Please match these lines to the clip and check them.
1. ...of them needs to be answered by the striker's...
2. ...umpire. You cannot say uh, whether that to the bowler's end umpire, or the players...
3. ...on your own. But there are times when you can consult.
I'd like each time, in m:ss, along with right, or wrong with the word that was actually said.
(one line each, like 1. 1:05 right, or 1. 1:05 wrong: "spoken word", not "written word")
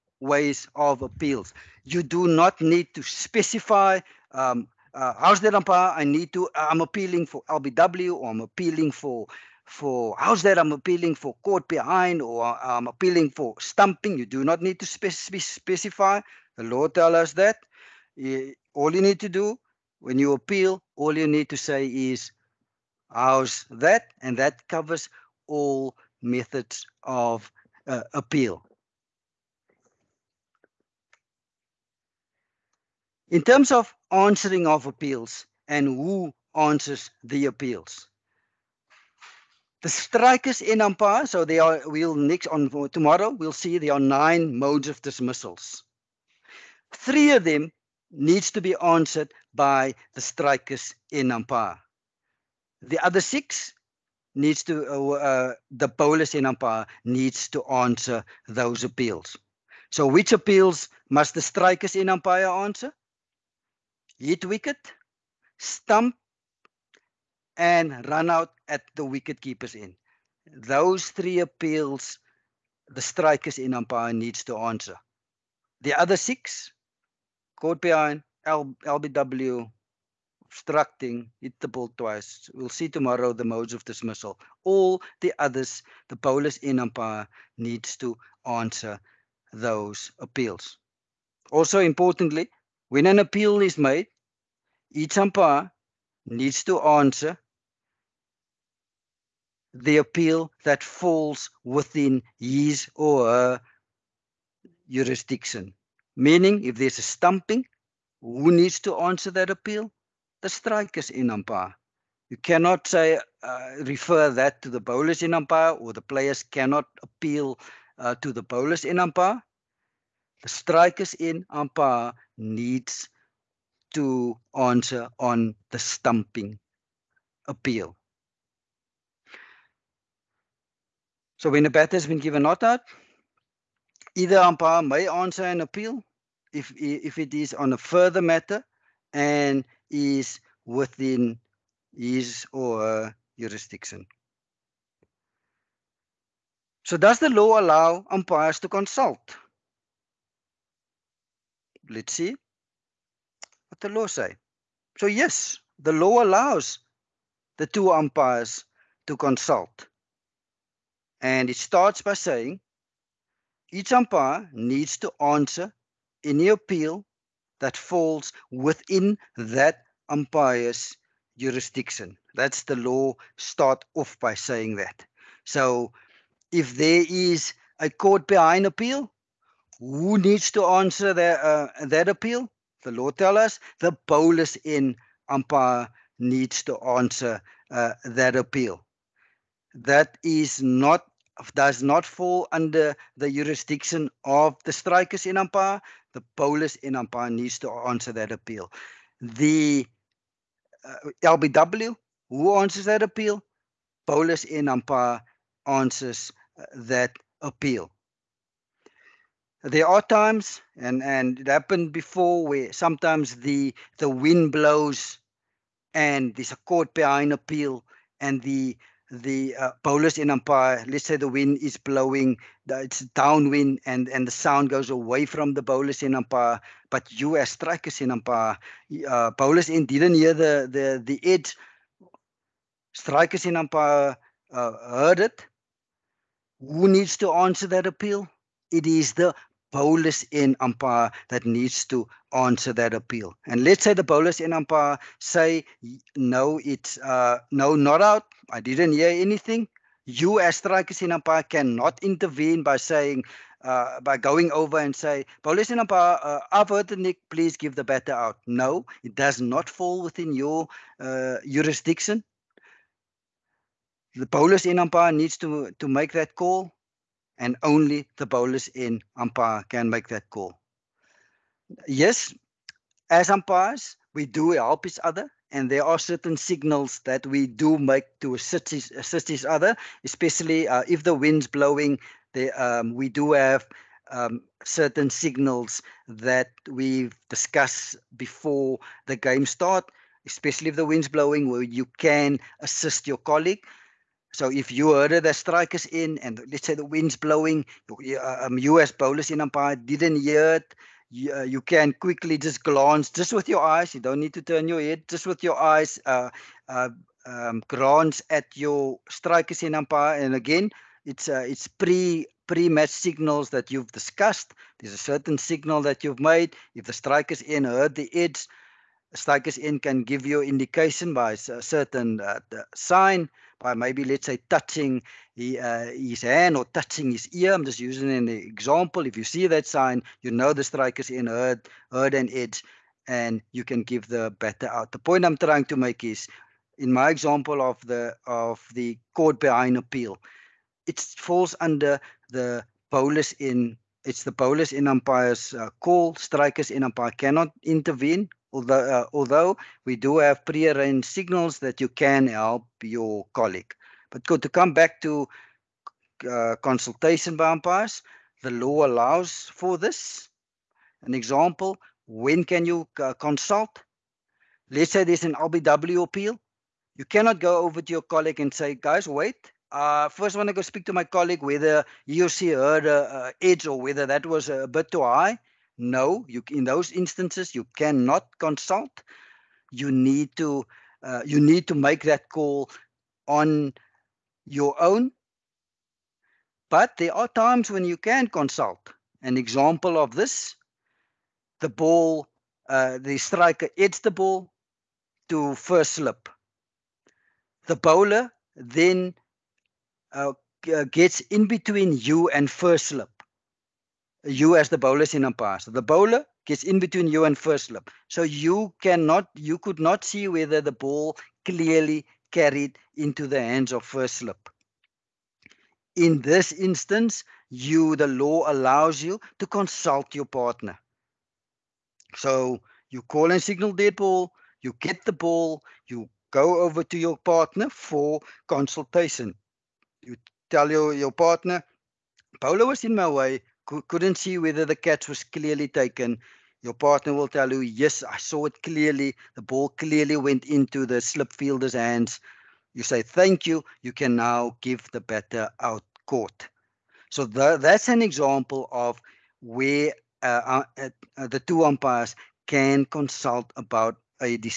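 1. 0:47 right
2. 1:51 wrong: "refer", not "whether"
3. 6:23 right.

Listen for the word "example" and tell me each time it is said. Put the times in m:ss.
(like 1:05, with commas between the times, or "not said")
5:28, 5:37, 6:01, 6:29, 7:28.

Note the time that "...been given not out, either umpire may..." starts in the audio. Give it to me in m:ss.
2:12.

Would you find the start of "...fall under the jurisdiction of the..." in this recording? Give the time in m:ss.
3:12.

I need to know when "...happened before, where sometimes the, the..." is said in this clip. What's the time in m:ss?
3:31.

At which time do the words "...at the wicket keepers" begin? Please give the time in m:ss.
1:08.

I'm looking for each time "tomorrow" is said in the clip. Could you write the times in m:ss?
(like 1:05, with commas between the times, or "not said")
0:42, 1:22.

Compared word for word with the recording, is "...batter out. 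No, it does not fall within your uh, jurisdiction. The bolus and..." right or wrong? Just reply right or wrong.
right.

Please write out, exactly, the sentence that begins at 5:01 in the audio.
You, uh, you, can quickly just glance, just with your eyes.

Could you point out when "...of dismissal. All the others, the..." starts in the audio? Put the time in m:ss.
1:23.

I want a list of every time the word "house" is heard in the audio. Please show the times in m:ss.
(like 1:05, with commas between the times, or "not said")
0:05, 0:10, 0:23.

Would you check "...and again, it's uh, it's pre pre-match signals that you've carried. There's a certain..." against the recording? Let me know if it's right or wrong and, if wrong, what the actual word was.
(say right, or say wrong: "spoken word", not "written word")
wrong: "discussed", not "carried".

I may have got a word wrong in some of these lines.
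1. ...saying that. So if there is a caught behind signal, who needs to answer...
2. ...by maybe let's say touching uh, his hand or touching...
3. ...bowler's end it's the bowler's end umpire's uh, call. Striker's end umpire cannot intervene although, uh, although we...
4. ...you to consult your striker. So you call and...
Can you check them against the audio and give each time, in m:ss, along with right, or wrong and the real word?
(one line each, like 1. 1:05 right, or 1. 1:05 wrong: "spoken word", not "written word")
1. 2:54 wrong: "appeal", not "signal"
2. 5:23 right
3. 5:42 right
4. 6:59 wrong: "partner", not "striker".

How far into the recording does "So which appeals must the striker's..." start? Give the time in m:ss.
0:59.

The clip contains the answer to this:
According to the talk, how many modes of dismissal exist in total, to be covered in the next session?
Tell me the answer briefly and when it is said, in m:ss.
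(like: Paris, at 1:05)
9, at 0:43.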